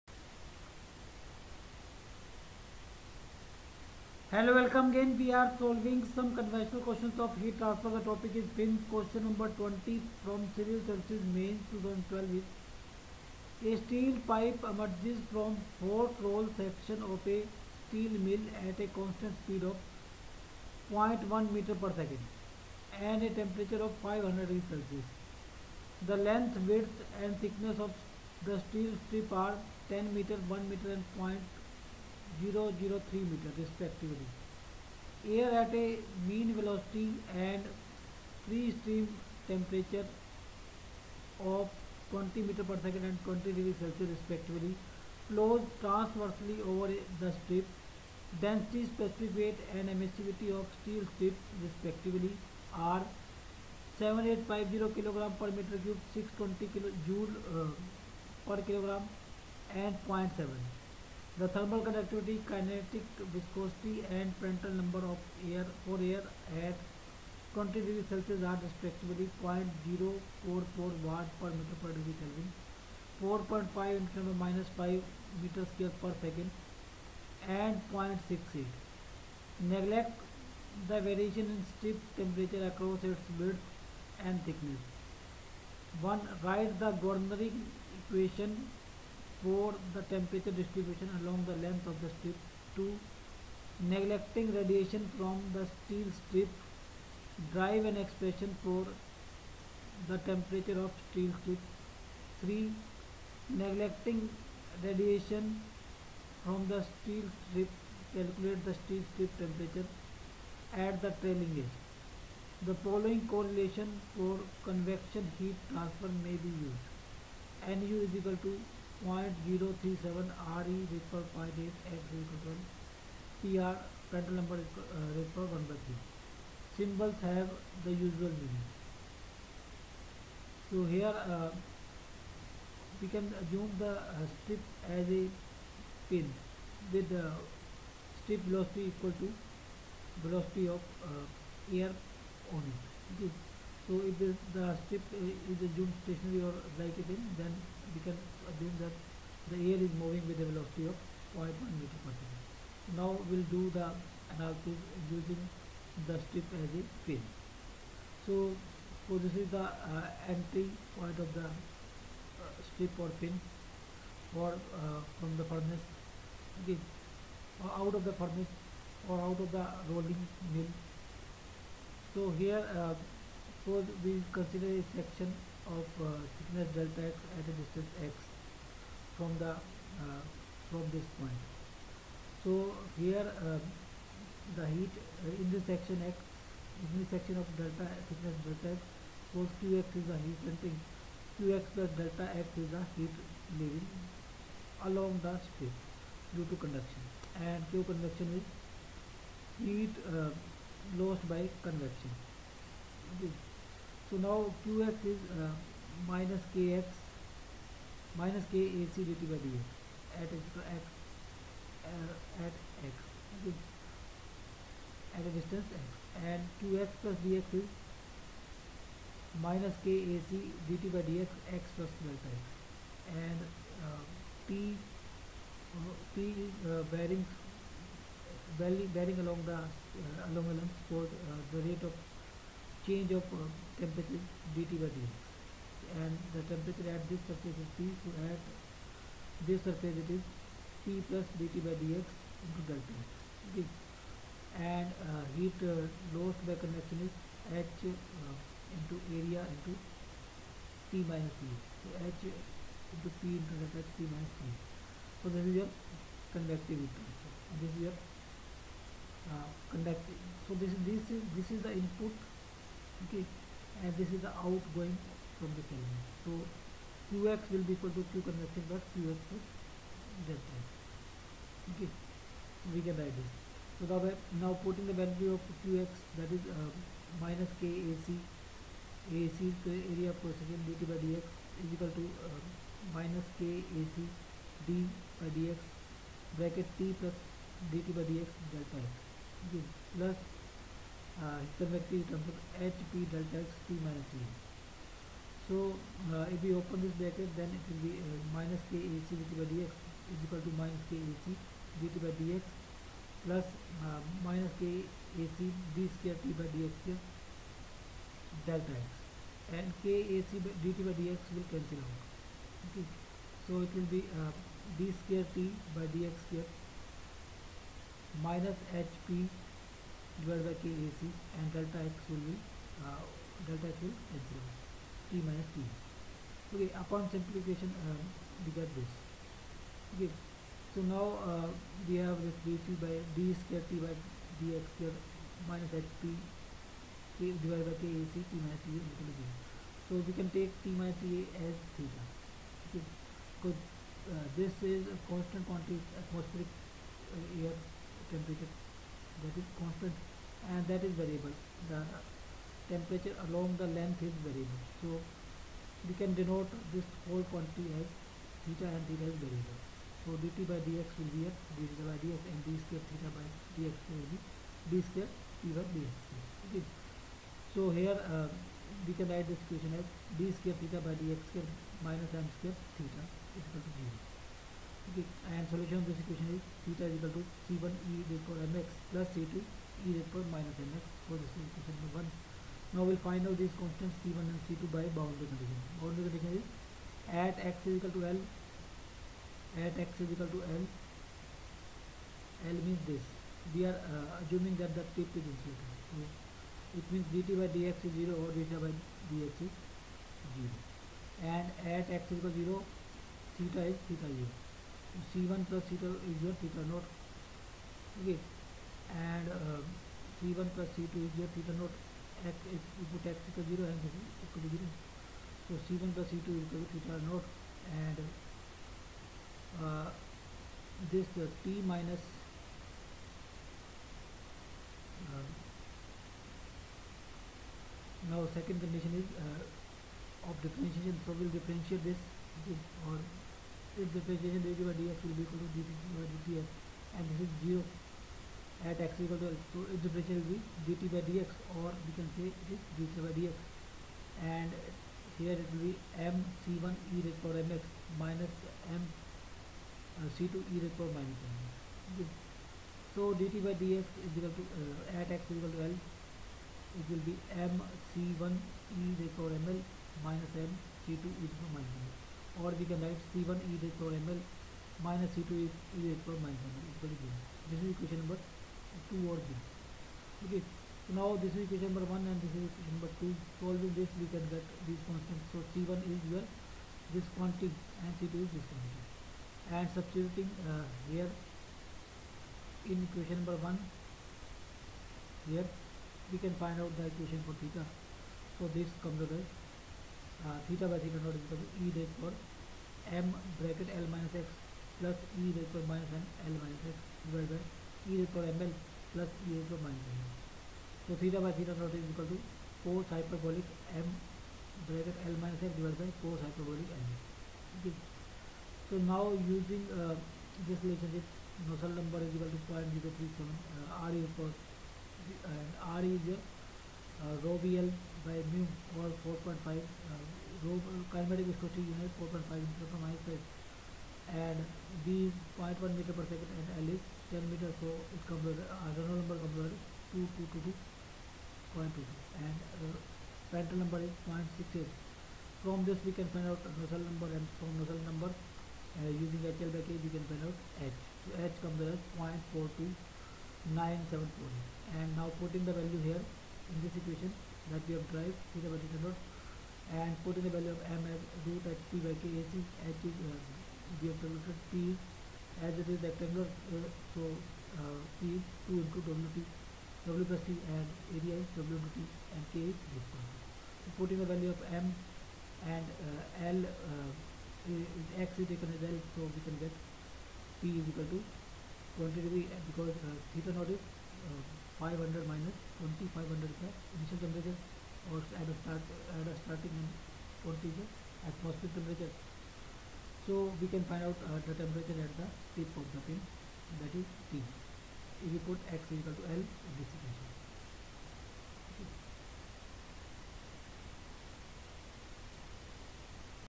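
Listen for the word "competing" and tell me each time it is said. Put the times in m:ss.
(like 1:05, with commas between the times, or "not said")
not said.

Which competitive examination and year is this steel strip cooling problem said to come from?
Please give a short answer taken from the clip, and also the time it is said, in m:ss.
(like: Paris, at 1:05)
Civil Services Mains 2012, at 0:10.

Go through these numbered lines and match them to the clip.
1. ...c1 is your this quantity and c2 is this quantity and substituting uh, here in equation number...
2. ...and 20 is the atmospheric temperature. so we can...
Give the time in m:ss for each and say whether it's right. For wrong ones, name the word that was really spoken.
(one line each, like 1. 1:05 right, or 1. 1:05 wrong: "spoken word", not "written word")
1. 7:55 right
2. 9:39 right.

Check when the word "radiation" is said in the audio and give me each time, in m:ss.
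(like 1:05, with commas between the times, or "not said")
1:34, 1:44.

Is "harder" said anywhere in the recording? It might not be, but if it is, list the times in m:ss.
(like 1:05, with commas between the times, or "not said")
not said.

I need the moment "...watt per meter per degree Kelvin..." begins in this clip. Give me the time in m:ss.
1:11.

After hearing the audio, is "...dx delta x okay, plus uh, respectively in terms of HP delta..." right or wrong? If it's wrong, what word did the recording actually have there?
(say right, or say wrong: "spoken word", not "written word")
wrong: "directly", not "respectively".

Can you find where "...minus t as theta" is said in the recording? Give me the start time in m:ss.
5:40.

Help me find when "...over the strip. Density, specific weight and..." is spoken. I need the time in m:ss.
0:46.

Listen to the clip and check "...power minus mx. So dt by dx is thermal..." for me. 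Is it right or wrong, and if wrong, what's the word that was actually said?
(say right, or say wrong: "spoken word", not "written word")
wrong: "equal", not "thermal".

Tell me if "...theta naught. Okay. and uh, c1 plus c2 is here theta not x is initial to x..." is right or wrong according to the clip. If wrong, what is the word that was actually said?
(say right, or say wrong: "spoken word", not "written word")
wrong: "equal", not "initial".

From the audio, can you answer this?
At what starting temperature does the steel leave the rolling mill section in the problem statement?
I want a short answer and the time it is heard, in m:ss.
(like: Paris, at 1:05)
500 degrees Celsius, at 0:24.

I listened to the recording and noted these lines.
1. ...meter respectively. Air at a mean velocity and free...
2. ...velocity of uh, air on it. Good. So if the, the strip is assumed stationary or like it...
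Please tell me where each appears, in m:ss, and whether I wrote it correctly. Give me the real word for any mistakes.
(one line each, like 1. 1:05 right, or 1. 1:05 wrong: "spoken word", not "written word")
1. 0:33 right
2. 2:20 right.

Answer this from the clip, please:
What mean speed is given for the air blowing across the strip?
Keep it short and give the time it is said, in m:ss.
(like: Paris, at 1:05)
20 meter per second, at 0:42.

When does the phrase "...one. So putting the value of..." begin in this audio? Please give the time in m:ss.
9:22.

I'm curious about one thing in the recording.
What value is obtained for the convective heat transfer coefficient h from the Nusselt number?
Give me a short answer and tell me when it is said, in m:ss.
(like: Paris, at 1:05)
0.42974, at 9:02.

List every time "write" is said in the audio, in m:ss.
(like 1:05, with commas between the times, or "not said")
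1:26, 4:33, 6:09, 7:42.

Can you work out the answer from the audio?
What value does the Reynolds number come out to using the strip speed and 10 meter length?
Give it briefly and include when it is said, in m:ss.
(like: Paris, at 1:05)
2222.22, at 8:49.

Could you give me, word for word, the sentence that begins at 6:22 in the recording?
Now we'll find out these constants c1 and c2 by boundary condition.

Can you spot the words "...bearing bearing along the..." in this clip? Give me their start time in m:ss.
3:46.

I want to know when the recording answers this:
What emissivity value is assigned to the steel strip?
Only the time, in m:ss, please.
1:00.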